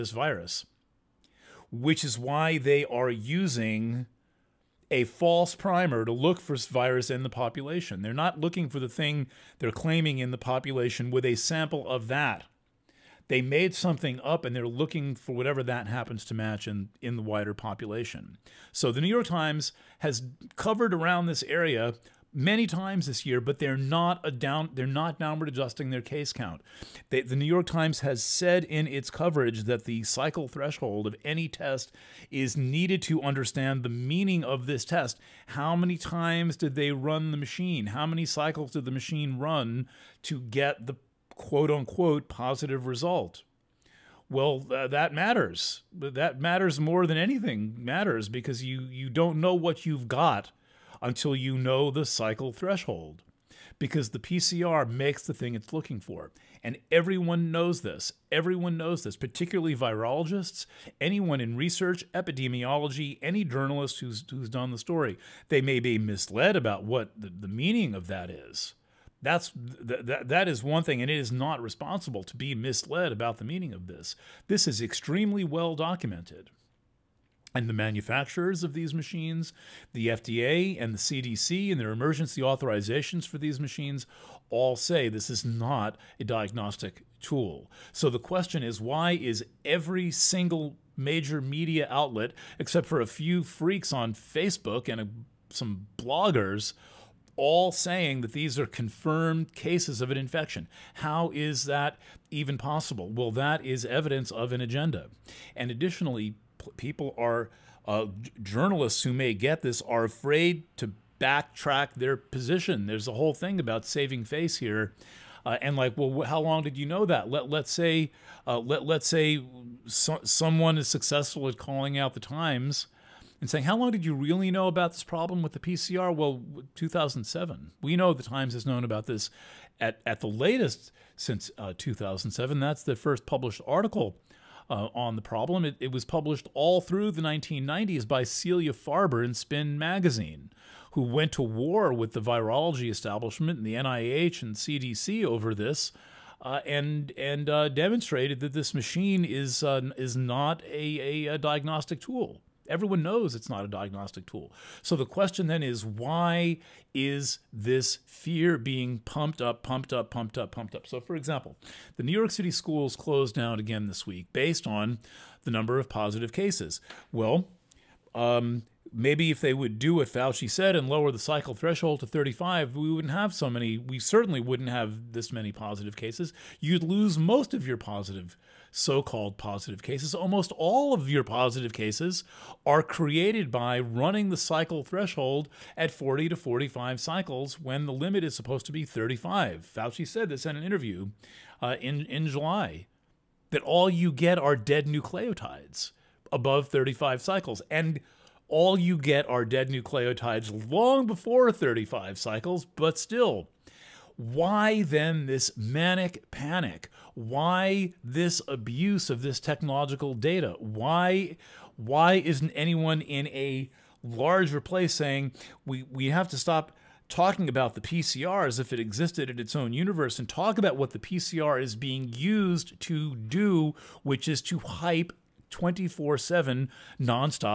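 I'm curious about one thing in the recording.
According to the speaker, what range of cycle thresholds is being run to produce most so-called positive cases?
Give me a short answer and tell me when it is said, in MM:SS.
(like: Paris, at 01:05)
40 to 45, at 03:05.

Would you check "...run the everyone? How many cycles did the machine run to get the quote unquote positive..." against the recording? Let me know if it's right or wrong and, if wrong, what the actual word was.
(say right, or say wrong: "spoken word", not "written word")
wrong: "machine", not "everyone".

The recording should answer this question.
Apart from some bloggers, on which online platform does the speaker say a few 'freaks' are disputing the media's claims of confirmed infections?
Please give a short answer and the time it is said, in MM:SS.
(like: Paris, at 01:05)
Facebook, at 01:34.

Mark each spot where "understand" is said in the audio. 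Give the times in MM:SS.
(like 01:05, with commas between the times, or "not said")
00:33.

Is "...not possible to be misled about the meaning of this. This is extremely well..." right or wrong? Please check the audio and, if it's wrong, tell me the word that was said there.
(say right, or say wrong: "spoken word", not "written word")
wrong: "responsible", not "possible".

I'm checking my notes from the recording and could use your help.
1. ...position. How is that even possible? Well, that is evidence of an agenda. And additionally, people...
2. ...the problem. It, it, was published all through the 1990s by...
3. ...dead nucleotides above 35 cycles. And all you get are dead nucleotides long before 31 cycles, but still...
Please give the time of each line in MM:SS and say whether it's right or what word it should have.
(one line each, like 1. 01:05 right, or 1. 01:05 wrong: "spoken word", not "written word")
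1. 01:40 wrong: "infection", not "position"
2. 02:15 right
3. 03:14 wrong: "35", not "31".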